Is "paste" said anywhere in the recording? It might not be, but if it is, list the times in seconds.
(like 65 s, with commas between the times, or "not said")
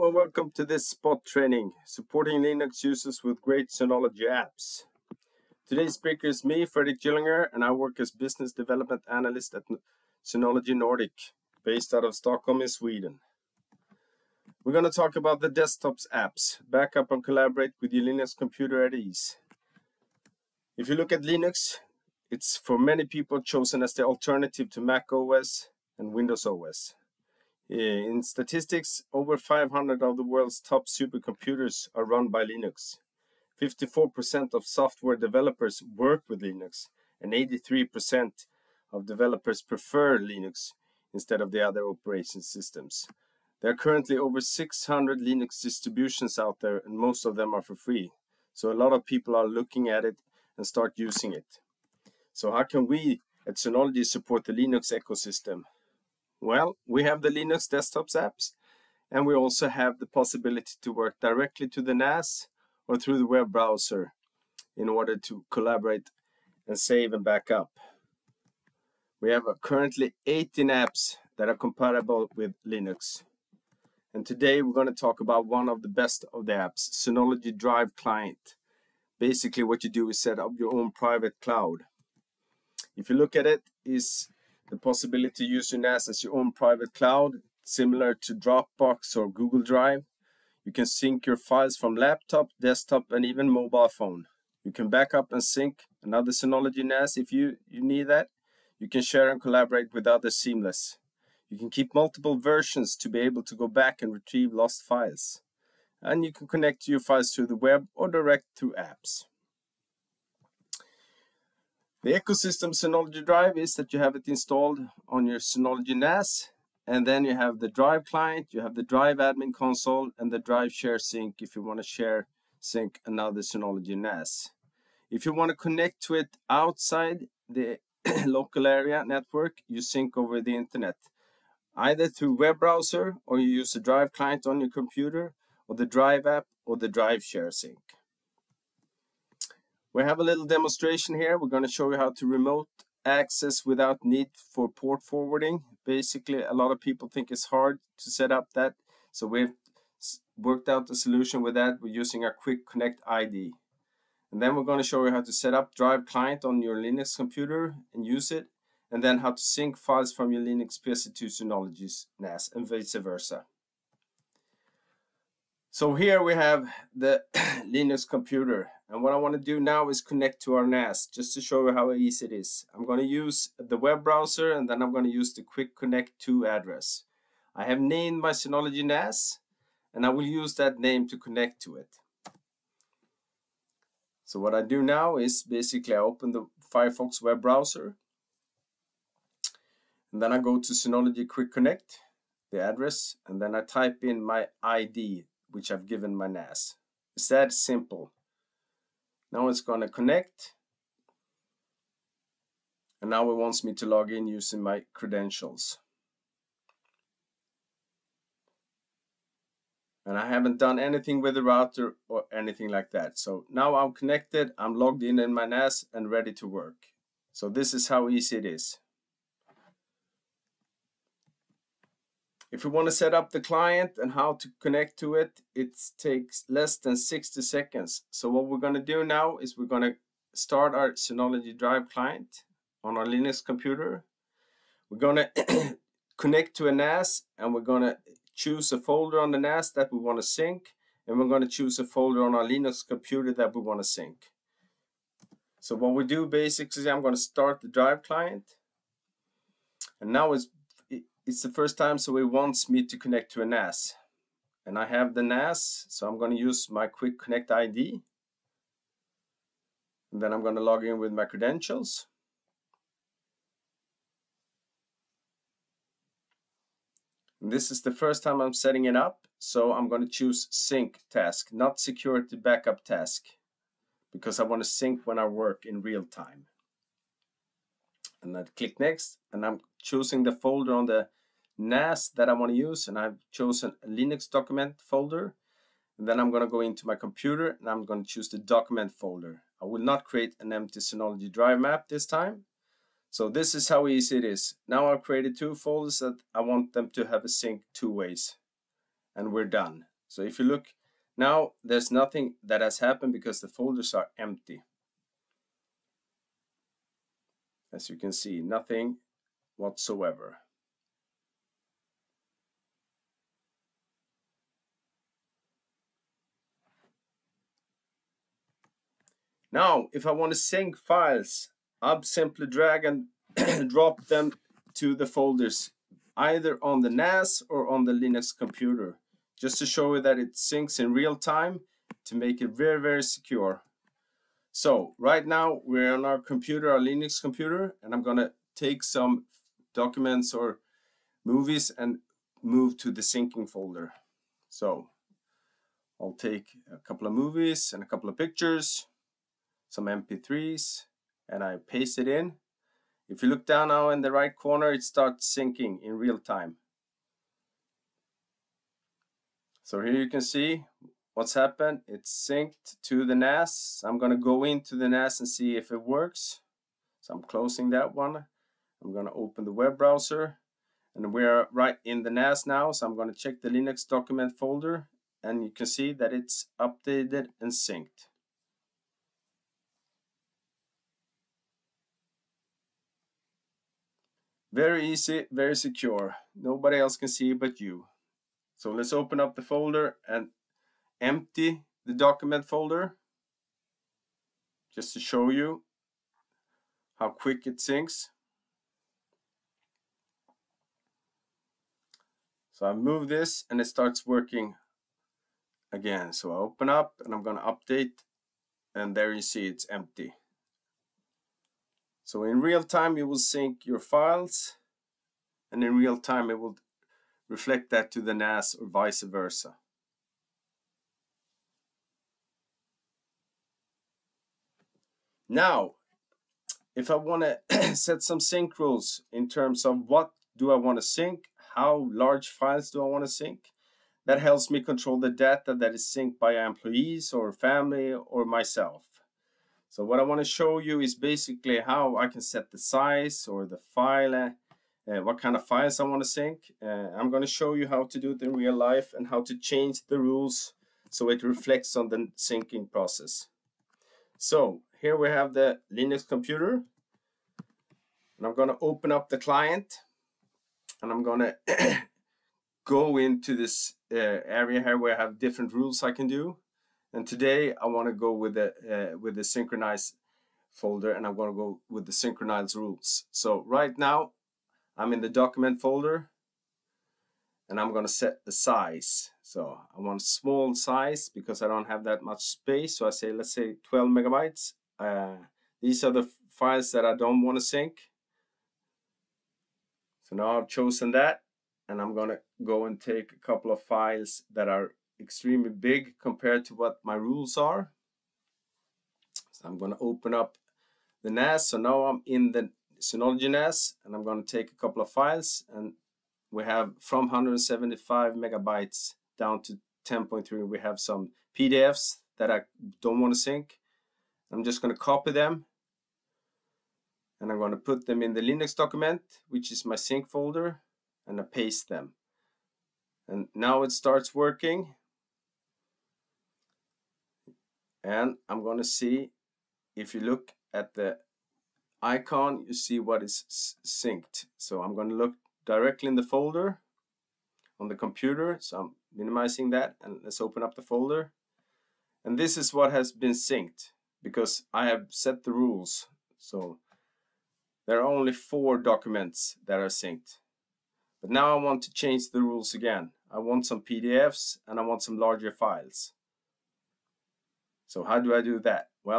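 351 s, 521 s.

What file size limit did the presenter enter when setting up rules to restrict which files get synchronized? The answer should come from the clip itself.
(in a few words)
12 megabytes.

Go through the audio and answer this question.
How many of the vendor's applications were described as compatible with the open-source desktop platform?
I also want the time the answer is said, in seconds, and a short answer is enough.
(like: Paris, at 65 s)
18, at 70 s.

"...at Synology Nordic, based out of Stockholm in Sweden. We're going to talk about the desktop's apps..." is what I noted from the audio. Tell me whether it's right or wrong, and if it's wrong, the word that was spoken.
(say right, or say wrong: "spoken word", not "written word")
right.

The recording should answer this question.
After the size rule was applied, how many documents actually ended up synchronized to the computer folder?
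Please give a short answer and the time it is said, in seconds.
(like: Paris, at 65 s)
4, at 548 s.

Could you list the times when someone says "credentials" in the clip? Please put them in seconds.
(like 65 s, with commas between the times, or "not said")
204 s, 261 s.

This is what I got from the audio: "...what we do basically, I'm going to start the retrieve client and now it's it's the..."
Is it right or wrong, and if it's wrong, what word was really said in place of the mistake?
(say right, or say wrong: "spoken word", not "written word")
wrong: "drive", not "retrieve".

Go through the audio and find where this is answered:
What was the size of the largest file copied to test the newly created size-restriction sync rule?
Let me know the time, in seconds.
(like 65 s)
507 s.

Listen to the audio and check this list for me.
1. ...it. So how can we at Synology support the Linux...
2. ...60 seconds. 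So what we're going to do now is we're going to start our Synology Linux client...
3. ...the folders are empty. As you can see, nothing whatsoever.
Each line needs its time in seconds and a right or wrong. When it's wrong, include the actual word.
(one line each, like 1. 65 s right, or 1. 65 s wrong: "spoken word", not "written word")
1. 51 s right
2. 226 s wrong: "Drive", not "Linux"
3. 303 s right.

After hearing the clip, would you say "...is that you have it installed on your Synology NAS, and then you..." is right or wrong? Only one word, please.
right.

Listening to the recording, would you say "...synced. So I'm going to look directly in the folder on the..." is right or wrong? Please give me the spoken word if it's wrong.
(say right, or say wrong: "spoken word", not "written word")
right.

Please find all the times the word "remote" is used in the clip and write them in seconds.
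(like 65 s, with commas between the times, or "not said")
142 s.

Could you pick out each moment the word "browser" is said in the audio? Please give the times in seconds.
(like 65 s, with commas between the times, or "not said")
63 s, 132 s, 174 s, 187 s, 369 s.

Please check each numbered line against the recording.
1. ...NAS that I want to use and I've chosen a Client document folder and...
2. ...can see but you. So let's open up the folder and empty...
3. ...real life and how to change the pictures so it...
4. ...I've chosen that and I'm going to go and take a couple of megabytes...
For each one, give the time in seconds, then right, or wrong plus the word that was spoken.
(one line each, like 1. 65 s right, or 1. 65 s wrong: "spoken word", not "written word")
1. 281 s wrong: "Linux", not "Client"
2. 386 s right
3. 448 s wrong: "rules", not "pictures"
4. 490 s wrong: "files", not "megabytes".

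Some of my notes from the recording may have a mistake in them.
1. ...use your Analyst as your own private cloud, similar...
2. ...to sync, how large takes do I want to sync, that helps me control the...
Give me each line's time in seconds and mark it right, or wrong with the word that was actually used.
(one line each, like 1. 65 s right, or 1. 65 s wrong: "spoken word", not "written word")
1. 85 s wrong: "NAS", not "Analyst"
2. 430 s wrong: "files", not "takes".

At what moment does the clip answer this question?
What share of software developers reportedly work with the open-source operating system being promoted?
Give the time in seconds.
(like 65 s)
33 s.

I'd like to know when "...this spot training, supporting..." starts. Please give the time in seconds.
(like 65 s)
0 s.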